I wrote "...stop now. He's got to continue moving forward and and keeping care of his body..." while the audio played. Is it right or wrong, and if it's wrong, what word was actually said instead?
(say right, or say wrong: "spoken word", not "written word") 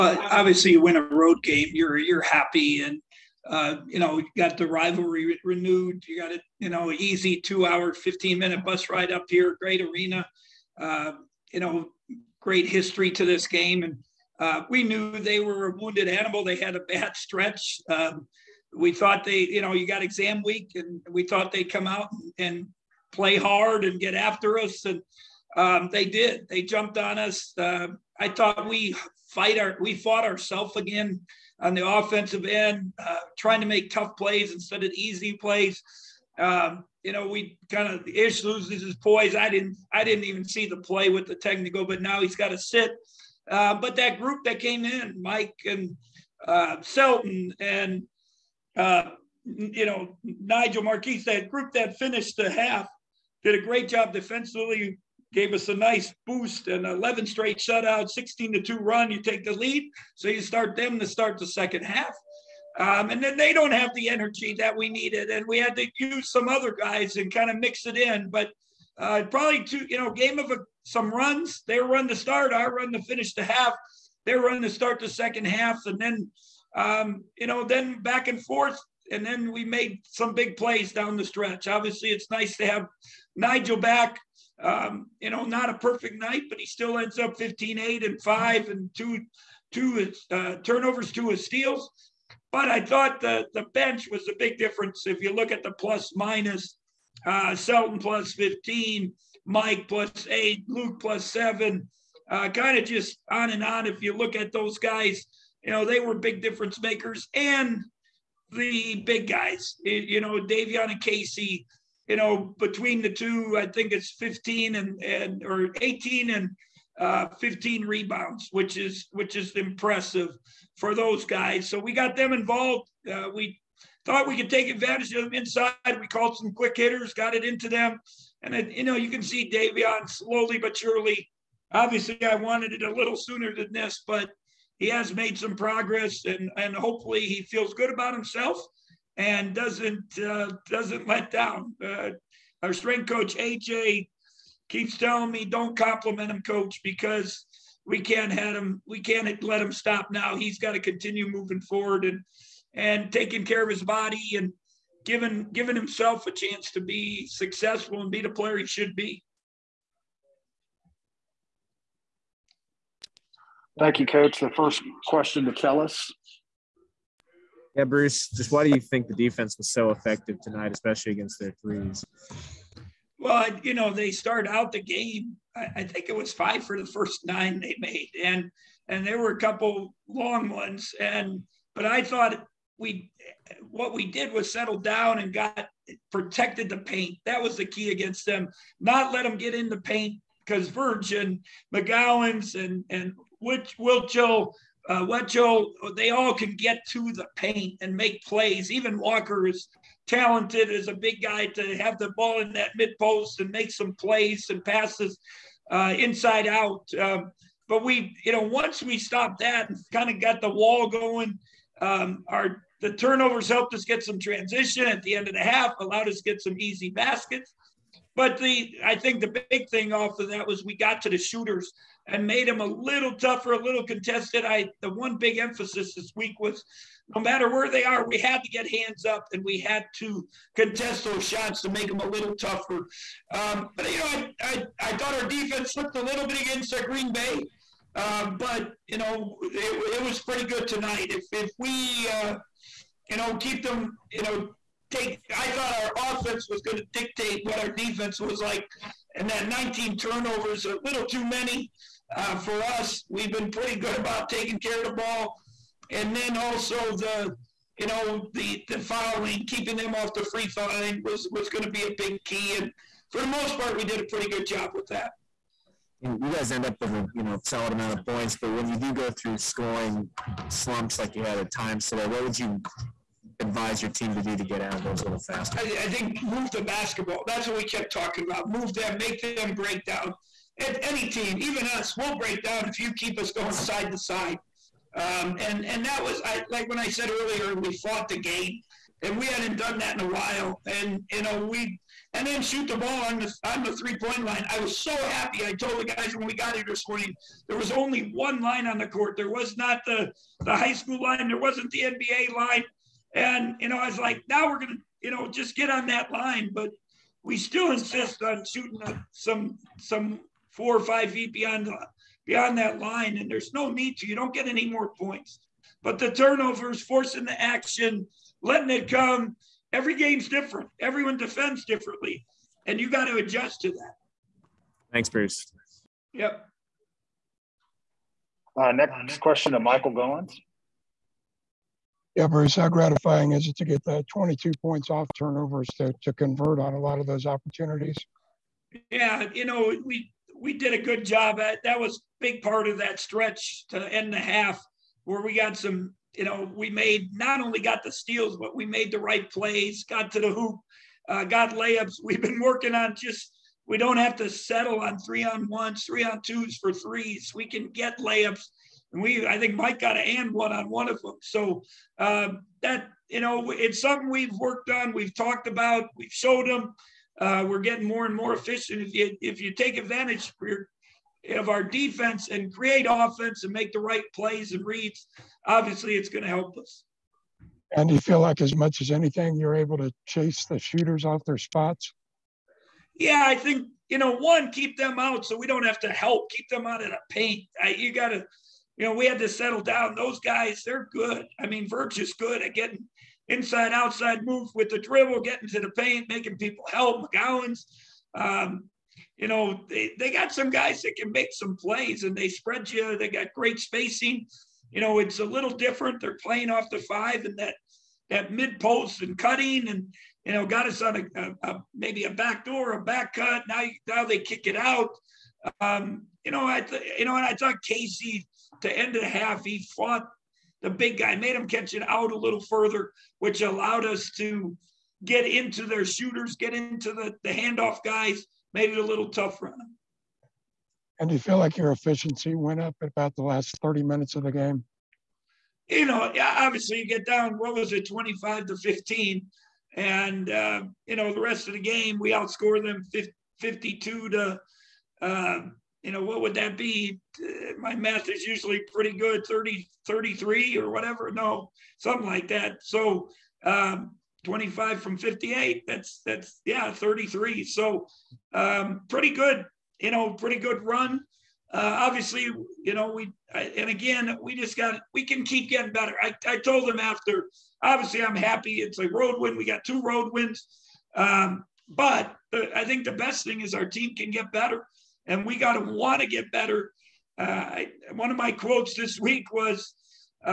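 wrong: "taking", not "keeping".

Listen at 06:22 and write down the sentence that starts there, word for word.
Yeah, I think, you know, one, keep them out so we don't have to help, keep them out of the paint.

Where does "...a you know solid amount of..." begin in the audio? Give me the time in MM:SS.
04:26.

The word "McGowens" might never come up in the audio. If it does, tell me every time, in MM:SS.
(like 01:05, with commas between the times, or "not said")
03:11, 06:37.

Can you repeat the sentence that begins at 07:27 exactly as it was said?
Uh, my math is usually pretty good, 30, 33 or whatever.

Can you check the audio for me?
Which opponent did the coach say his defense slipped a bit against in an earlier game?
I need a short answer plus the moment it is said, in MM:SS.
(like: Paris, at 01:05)
Green Bay, at 03:56.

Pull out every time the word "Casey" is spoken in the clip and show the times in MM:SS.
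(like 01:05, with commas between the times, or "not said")
01:51, 06:57.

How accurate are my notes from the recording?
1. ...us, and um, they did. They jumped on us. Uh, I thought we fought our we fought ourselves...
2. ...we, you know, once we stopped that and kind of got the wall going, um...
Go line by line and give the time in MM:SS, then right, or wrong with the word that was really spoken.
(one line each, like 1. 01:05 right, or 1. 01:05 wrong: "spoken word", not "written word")
1. 00:24 wrong: "fight", not "fought"
2. 03:27 right.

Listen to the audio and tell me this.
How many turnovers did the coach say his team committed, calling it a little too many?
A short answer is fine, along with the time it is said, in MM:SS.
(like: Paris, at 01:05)
19, at 04:09.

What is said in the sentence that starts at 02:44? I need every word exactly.
The first question to tell us.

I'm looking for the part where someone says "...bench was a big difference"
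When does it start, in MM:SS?
01:33.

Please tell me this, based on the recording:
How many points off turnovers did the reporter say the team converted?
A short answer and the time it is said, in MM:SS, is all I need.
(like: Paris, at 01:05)
22, at 05:34.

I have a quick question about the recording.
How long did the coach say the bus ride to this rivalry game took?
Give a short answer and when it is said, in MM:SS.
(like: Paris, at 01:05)
2 hours 15 minutes, at 00:07.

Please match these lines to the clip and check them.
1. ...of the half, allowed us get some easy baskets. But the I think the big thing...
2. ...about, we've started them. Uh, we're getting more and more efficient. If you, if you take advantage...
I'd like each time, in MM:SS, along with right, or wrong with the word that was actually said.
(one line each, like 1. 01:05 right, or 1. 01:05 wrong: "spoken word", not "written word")
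1. 03:35 right
2. 06:05 wrong: "showed", not "started".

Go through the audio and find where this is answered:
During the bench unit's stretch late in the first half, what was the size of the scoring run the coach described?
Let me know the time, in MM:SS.
00:58.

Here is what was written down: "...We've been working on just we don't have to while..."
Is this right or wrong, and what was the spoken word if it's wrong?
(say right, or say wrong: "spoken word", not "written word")
wrong: "settle", not "while".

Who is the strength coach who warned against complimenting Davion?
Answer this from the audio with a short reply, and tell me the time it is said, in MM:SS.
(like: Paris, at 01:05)
AJ, at 02:23.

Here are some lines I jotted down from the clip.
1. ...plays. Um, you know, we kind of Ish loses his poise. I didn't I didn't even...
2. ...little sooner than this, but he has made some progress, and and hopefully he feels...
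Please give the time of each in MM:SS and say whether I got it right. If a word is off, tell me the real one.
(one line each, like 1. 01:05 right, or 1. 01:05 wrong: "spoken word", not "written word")
1. 00:35 right
2. 02:12 right.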